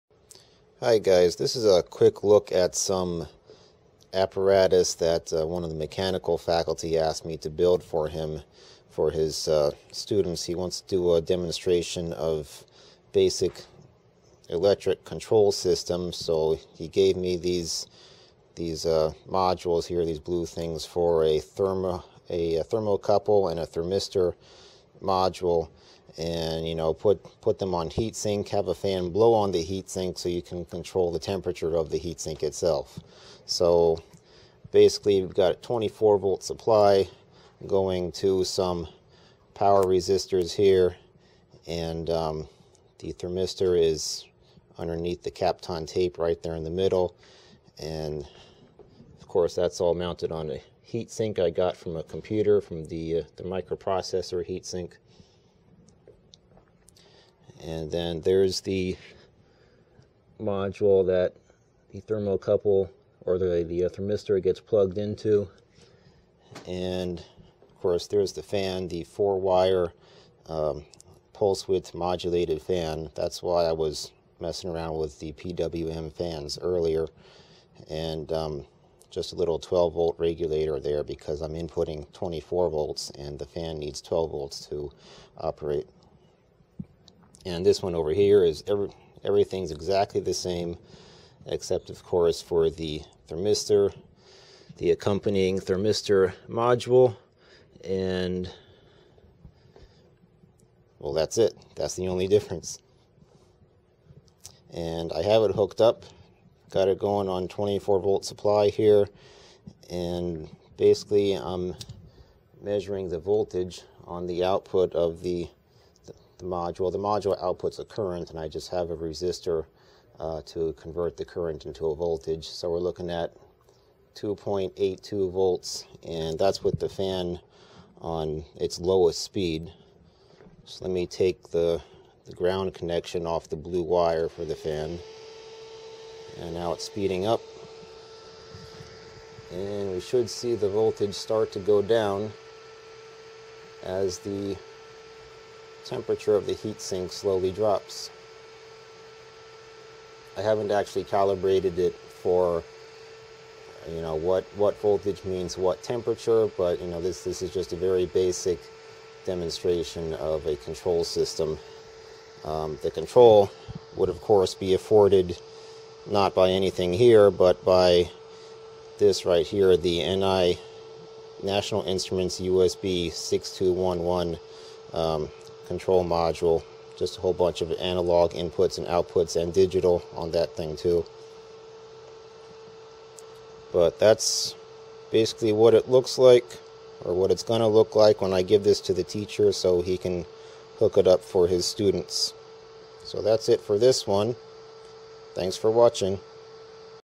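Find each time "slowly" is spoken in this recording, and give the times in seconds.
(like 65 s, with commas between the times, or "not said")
147 s.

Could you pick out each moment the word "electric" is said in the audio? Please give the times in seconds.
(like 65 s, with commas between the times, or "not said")
14 s.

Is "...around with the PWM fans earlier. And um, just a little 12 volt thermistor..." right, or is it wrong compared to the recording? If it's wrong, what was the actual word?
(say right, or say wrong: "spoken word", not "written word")
wrong: "regulator", not "thermistor".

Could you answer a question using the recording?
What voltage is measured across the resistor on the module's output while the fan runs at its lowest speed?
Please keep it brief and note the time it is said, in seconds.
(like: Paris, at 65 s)
2.82 volts, at 124 s.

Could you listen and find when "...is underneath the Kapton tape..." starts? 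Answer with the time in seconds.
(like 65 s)
43 s.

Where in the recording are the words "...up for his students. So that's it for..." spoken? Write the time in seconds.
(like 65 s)
191 s.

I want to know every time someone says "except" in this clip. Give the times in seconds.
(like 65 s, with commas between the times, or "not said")
91 s.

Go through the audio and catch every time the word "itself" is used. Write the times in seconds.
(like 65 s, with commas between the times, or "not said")
32 s.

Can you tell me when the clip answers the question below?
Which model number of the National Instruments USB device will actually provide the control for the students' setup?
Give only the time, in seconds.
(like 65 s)
172 s.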